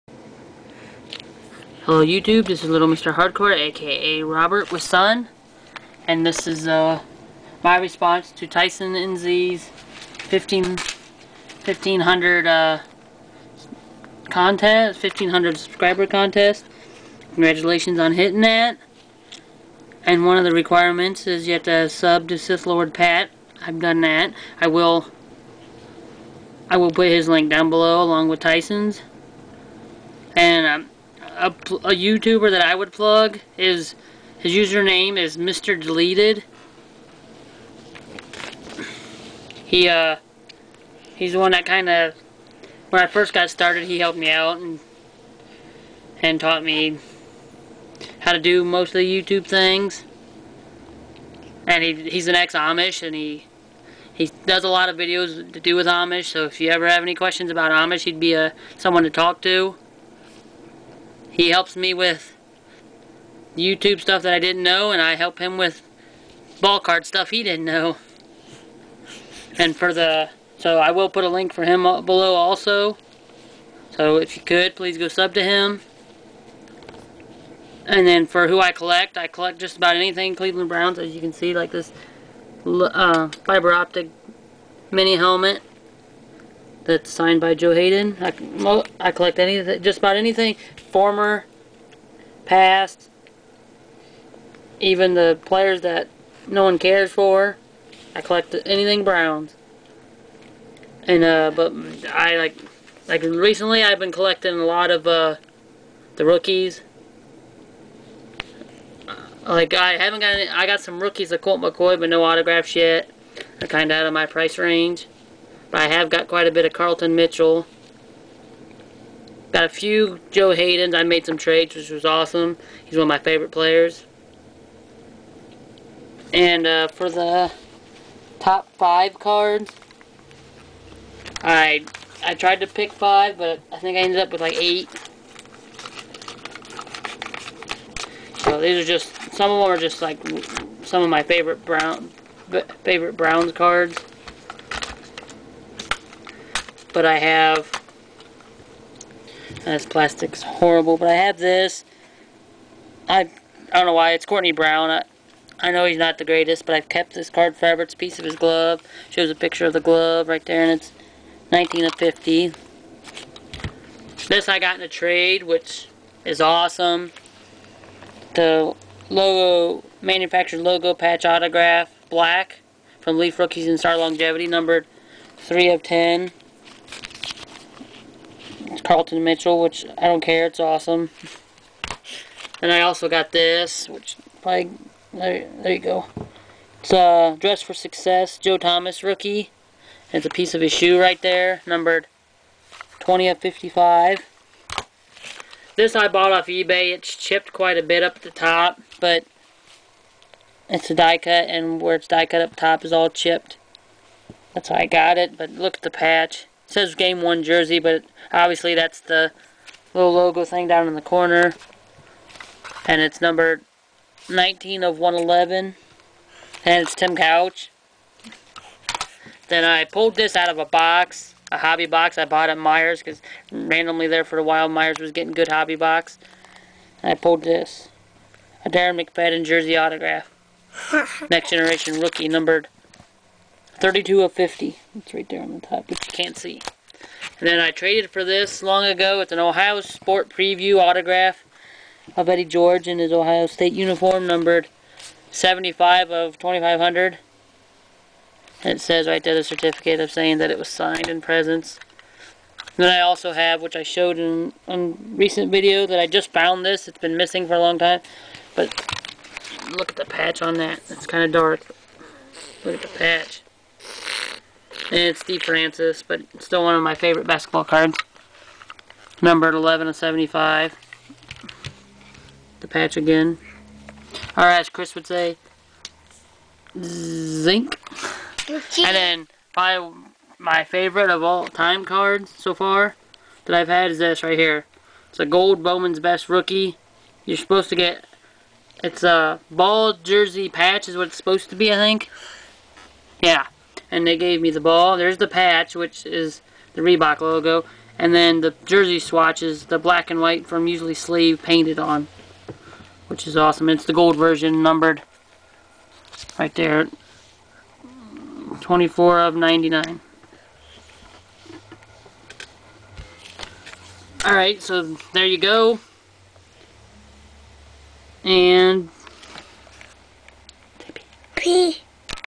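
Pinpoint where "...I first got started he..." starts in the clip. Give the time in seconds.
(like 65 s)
43 s.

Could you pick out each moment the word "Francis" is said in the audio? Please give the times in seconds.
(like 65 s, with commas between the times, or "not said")
265 s.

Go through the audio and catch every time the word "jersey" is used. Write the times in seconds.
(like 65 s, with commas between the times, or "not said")
207 s, 229 s, 289 s, 298 s.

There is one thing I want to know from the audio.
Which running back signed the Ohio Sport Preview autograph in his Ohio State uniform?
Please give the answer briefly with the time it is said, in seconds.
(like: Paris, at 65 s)
Eddie George, at 242 s.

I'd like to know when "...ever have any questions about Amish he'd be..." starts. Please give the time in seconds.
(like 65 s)
56 s.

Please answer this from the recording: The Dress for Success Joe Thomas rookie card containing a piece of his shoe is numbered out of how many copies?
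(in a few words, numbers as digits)
55.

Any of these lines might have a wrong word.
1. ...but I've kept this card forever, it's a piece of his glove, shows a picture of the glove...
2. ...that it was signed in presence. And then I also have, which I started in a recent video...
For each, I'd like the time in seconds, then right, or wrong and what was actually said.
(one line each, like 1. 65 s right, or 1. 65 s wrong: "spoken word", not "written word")
1. 156 s right
2. 250 s wrong: "showed", not "started".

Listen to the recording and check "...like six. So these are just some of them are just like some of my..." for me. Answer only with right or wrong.
wrong.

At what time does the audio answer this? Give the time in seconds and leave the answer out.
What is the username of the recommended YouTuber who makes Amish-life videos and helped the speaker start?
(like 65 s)
35 s.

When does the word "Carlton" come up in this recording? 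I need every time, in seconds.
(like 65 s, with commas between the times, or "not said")
116 s, 178 s.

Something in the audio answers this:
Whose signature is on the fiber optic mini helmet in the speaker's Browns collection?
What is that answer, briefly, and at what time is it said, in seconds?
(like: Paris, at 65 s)
Joe Haden, at 87 s.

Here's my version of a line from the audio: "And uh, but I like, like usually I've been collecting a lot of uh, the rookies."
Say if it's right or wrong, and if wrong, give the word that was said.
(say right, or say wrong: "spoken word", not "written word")
wrong: "recently", not "usually".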